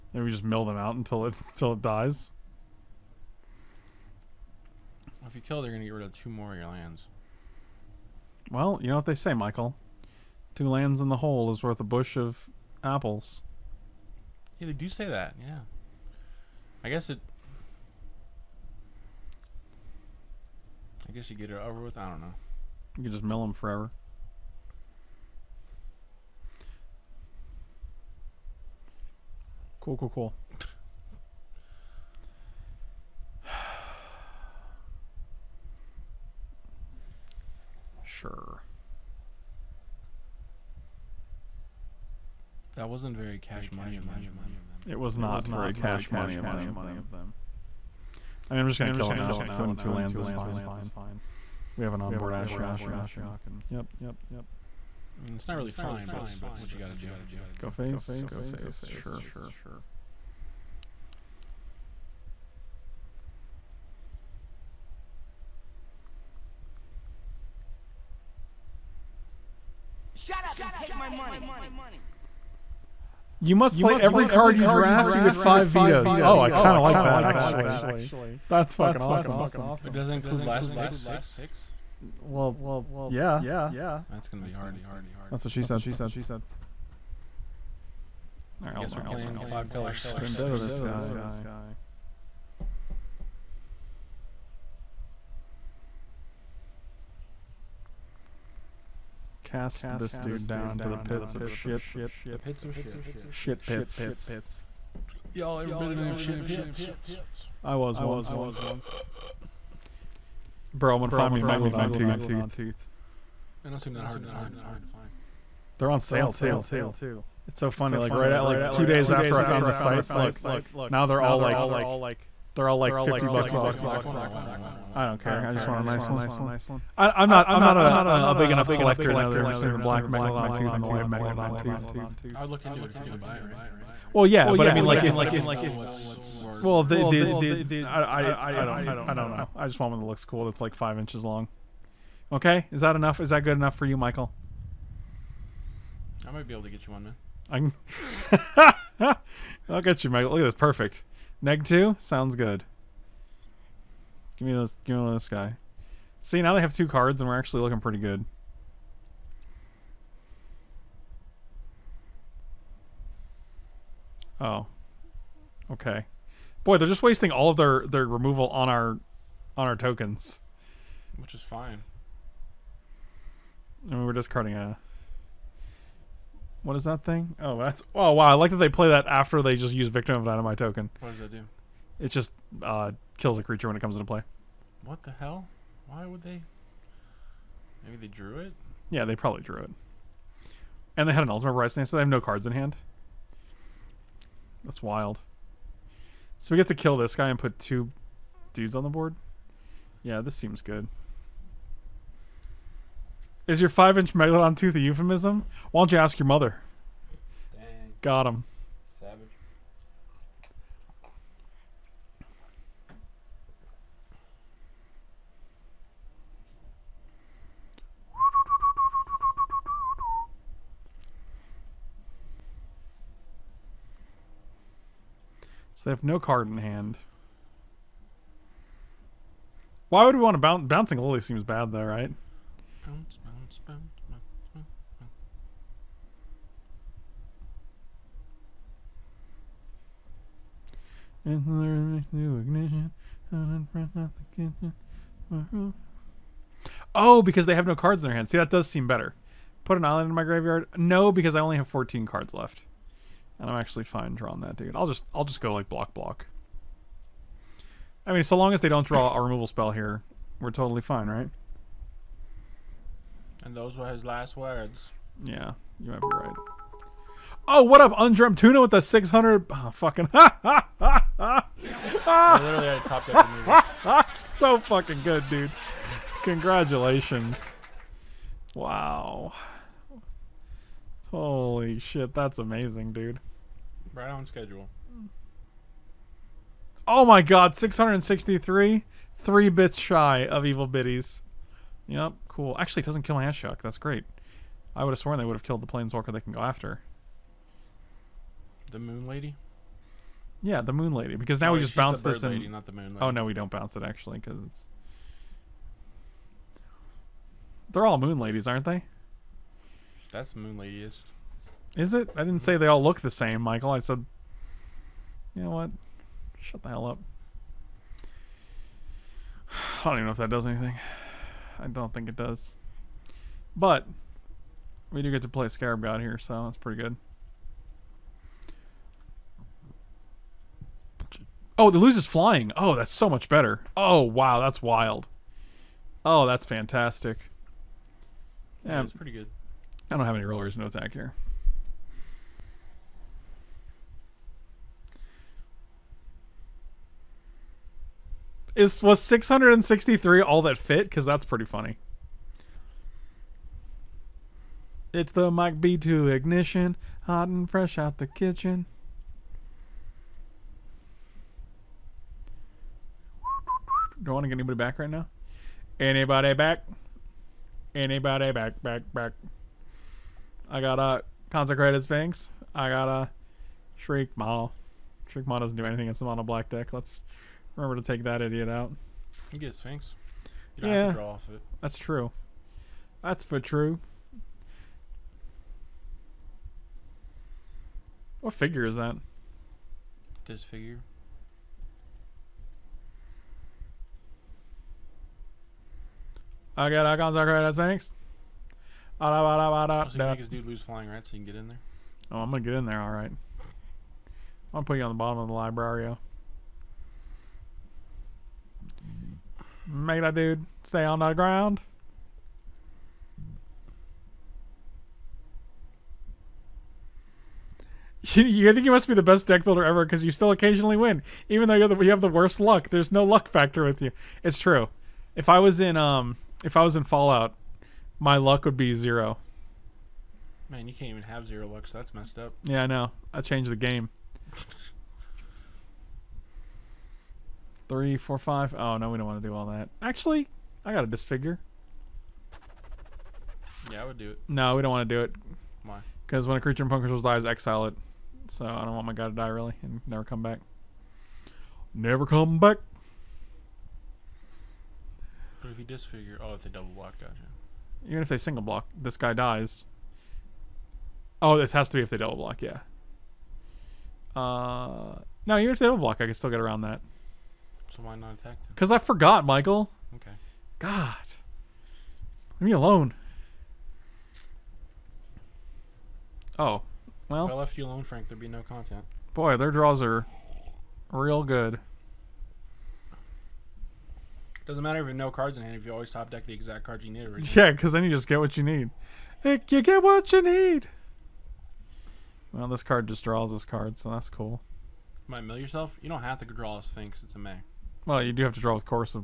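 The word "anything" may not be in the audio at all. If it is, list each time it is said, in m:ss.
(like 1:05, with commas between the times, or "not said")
5:20, 6:15.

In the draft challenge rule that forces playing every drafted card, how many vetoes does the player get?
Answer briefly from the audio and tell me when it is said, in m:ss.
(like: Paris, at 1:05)
5, at 1:15.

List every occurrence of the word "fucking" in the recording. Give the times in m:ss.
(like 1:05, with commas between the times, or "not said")
1:18, 4:29, 4:34.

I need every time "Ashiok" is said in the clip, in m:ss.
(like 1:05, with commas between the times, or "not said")
0:52, 4:53.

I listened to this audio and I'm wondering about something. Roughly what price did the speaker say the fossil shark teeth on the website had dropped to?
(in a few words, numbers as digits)
50 bucks.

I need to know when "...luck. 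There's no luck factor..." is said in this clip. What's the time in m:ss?
7:02.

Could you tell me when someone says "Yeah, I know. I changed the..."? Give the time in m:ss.
7:12.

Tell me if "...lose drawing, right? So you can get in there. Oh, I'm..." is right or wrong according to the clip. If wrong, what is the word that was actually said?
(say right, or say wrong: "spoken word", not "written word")
wrong: "flying", not "drawing".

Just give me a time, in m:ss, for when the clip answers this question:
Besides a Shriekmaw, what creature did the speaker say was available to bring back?
6:11.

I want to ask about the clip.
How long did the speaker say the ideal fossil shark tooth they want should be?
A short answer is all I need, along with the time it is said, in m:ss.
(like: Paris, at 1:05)
5 inches, at 2:20.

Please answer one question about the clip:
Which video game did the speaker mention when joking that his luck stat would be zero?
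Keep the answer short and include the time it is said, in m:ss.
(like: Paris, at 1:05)
Fallout, at 7:06.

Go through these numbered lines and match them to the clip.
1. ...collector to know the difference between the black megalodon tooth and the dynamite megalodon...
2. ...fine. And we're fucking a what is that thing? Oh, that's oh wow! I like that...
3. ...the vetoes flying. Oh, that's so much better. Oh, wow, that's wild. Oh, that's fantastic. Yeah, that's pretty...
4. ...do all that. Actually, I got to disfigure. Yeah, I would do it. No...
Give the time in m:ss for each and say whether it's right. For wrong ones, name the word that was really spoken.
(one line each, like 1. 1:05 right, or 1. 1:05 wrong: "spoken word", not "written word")
1. 2:08 wrong: "white", not "dynamite"
2. 2:51 wrong: "discarding", not "fucking"
3. 5:31 wrong: "loses", not "vetoes"
4. 7:19 right.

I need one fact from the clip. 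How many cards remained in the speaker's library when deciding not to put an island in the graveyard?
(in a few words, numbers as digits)
14.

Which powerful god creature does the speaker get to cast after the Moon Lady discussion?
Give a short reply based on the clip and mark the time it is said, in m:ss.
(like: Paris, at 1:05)
Scarab God, at 5:25.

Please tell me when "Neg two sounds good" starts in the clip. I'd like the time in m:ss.
2:31.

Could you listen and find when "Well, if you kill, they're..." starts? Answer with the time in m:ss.
0:05.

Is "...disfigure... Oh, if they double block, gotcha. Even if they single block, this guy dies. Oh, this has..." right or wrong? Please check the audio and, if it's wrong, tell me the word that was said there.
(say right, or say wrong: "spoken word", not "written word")
right.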